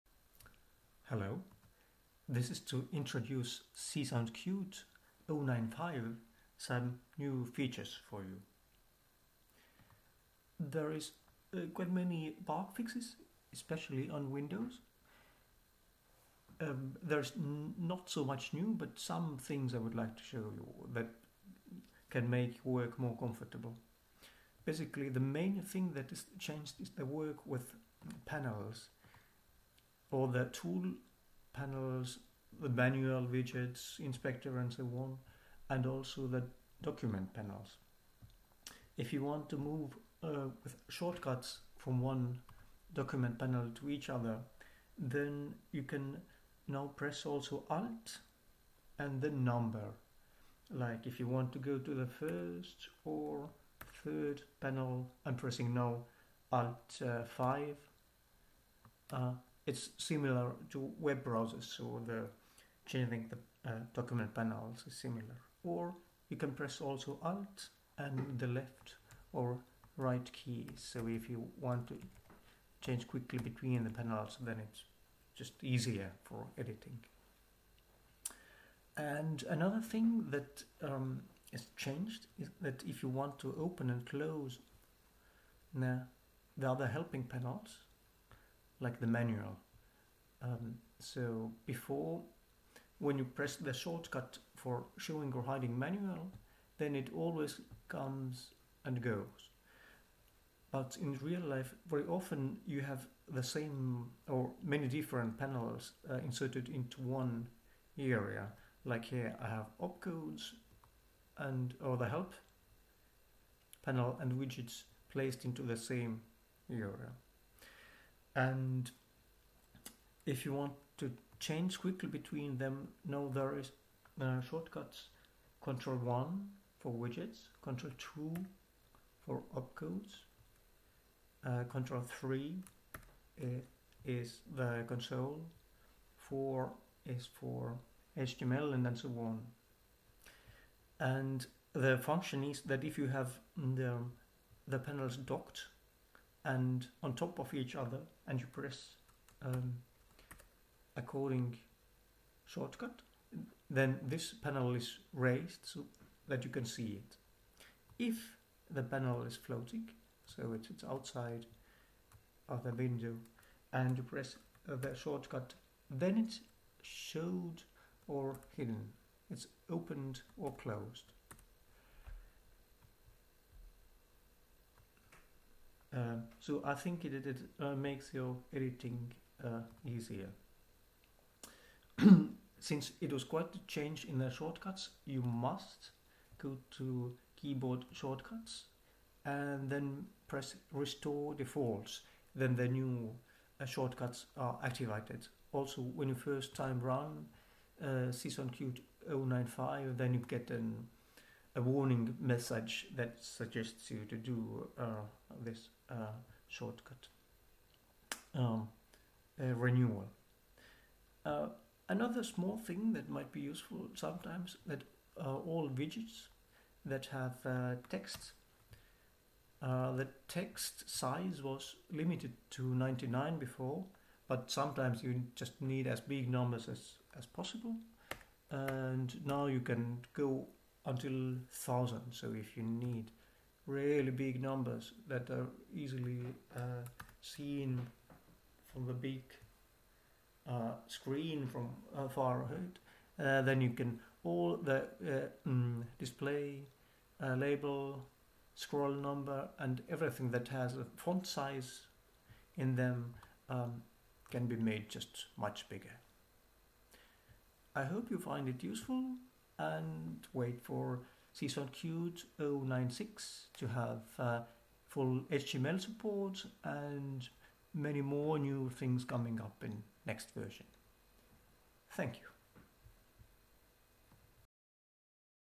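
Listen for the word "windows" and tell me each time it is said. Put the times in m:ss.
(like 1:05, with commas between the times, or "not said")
0:14, 2:42.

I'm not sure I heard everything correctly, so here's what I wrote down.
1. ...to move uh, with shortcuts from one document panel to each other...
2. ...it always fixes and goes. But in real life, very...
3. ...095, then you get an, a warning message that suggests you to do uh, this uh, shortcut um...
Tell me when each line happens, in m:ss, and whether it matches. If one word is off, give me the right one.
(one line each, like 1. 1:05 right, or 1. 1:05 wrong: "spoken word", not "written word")
1. 0:39 right
2. 1:36 wrong: "comes", not "fixes"
3. 3:19 right.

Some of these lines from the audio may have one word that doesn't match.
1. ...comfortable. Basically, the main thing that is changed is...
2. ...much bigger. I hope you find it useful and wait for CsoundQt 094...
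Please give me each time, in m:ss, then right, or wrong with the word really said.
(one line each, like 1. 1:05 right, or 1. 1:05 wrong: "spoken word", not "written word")
1. 0:23 right
2. 4:15 wrong: "096", not "094".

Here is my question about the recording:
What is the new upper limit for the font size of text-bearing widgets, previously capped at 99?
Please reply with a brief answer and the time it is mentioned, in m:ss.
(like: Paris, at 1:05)
1000, at 3:51.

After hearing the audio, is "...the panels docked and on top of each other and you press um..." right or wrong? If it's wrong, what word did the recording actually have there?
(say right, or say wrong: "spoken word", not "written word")
right.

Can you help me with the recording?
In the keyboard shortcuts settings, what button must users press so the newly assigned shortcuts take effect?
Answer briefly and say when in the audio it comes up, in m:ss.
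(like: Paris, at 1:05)
Restore defaults, at 3:10.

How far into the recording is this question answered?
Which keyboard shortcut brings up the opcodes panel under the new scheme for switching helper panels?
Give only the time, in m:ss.
2:07.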